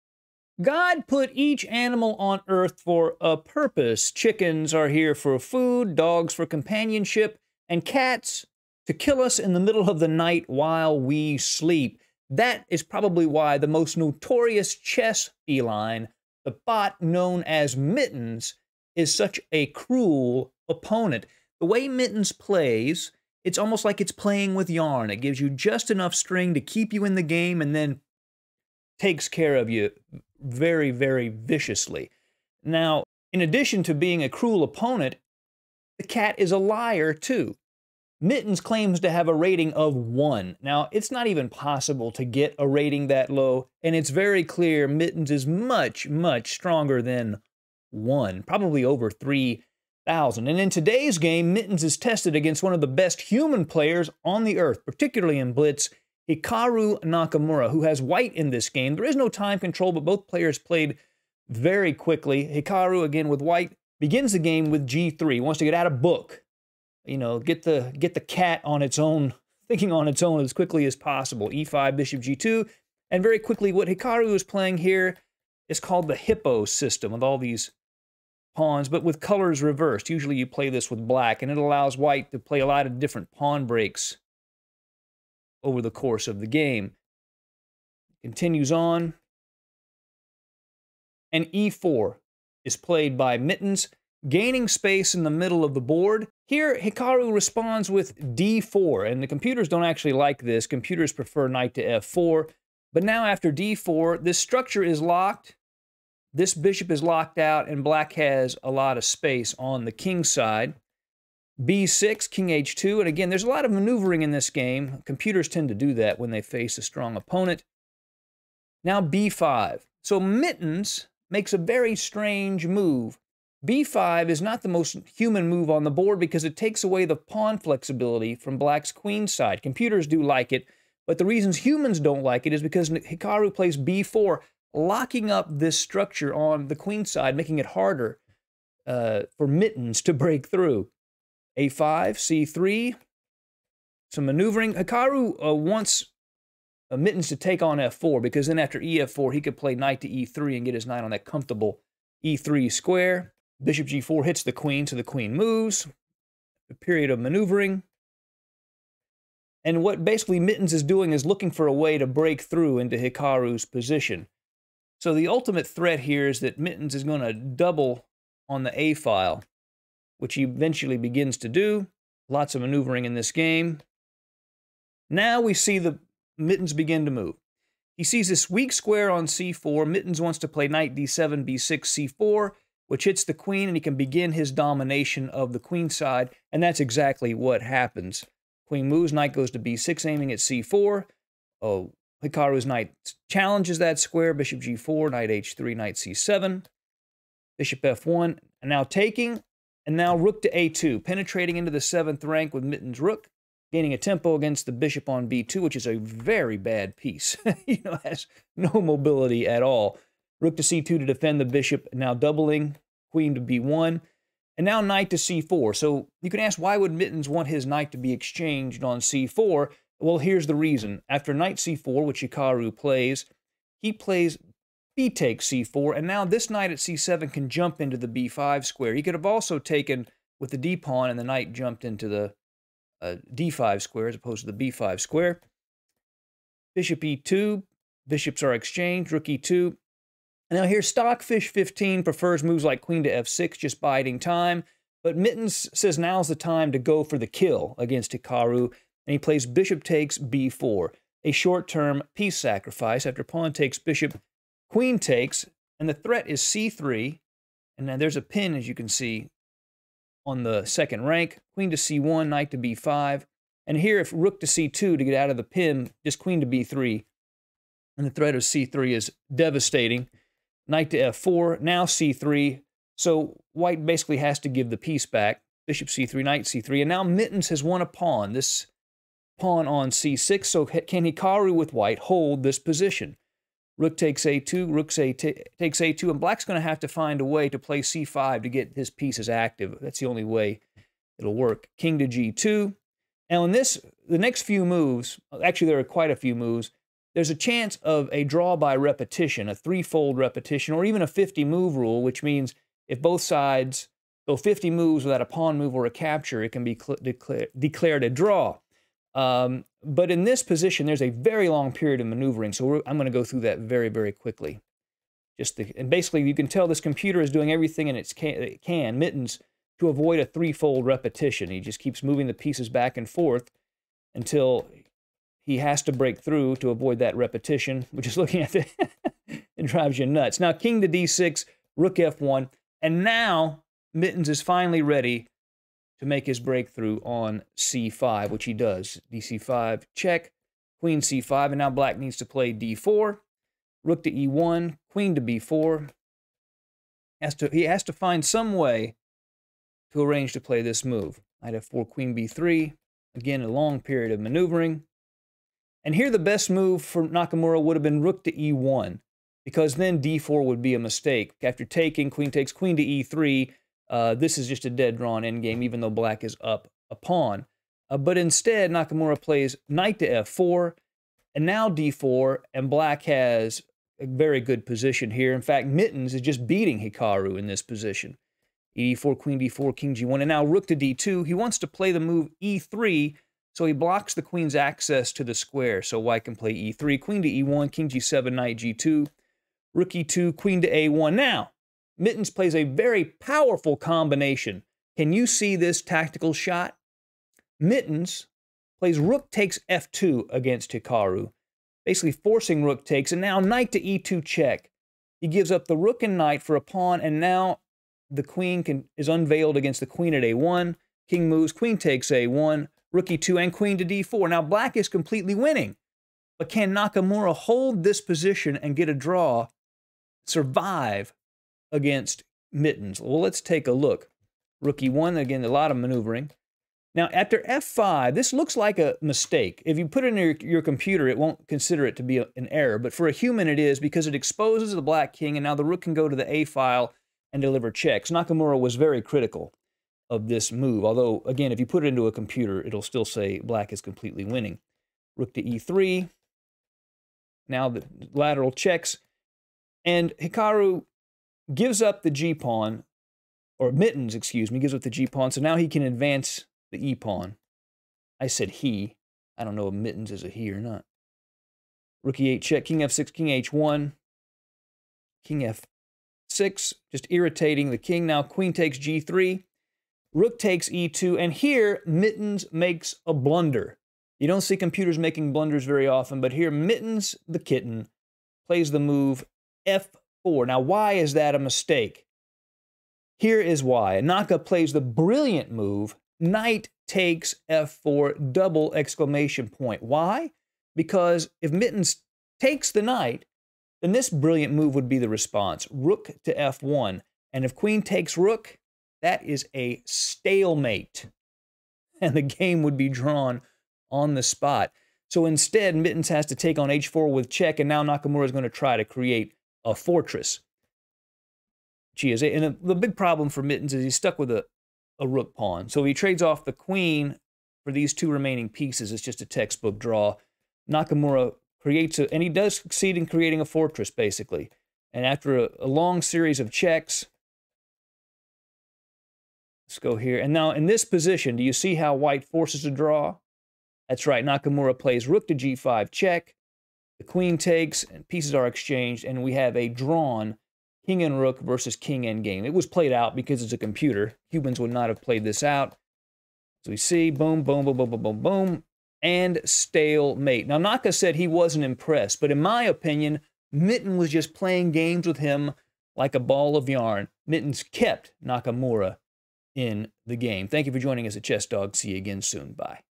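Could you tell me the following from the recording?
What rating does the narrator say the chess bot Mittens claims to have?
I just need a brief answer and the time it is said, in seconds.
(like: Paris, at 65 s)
1, at 39 s.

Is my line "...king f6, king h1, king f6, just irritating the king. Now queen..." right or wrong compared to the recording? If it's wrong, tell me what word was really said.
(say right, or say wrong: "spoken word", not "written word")
right.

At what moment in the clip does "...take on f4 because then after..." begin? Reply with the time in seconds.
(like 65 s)
147 s.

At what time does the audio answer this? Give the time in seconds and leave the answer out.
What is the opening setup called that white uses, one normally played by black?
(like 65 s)
76 s.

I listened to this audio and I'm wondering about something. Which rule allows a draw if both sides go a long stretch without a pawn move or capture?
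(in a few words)
50-move rule.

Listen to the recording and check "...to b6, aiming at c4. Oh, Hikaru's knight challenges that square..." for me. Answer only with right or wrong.
right.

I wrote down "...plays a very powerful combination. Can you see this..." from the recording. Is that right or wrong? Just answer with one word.
right.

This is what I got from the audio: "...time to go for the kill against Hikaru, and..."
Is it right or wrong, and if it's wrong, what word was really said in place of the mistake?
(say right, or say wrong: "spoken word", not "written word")
right.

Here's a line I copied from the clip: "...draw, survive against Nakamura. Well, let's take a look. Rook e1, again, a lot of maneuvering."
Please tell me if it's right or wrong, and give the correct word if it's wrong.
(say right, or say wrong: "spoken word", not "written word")
wrong: "Mittens", not "Nakamura".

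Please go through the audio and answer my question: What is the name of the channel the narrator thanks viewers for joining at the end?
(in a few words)
ChessDawg.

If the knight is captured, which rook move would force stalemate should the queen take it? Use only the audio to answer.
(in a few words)
rook to f1.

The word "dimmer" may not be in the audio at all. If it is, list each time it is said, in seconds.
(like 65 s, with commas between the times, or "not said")
not said.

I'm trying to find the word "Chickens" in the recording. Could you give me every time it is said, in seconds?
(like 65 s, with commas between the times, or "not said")
4 s.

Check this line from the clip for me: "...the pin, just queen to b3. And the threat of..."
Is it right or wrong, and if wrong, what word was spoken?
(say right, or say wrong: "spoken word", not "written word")
right.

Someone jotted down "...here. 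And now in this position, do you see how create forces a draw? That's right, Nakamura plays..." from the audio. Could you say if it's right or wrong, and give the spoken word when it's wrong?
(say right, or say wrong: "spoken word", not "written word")
wrong: "white", not "create".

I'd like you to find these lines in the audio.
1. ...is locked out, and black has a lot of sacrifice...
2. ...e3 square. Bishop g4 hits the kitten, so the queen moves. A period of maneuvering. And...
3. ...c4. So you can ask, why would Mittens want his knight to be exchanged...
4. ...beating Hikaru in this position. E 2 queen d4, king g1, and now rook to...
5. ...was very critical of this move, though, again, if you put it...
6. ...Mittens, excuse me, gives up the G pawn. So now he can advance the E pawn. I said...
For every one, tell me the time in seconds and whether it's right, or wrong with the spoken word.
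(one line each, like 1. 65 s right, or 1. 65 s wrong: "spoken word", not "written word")
1. 106 s wrong: "space", not "sacrifice"
2. 152 s wrong: "queen", not "kitten"
3. 215 s right
4. 376 s wrong: "4", not "2"
5. 438 s wrong: "although", not "though"
6. 453 s right.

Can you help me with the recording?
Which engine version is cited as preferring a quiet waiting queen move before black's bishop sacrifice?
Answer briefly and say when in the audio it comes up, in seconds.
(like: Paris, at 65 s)
Stockfish 15, at 240 s.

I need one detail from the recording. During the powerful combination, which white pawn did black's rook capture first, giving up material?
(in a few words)
f2.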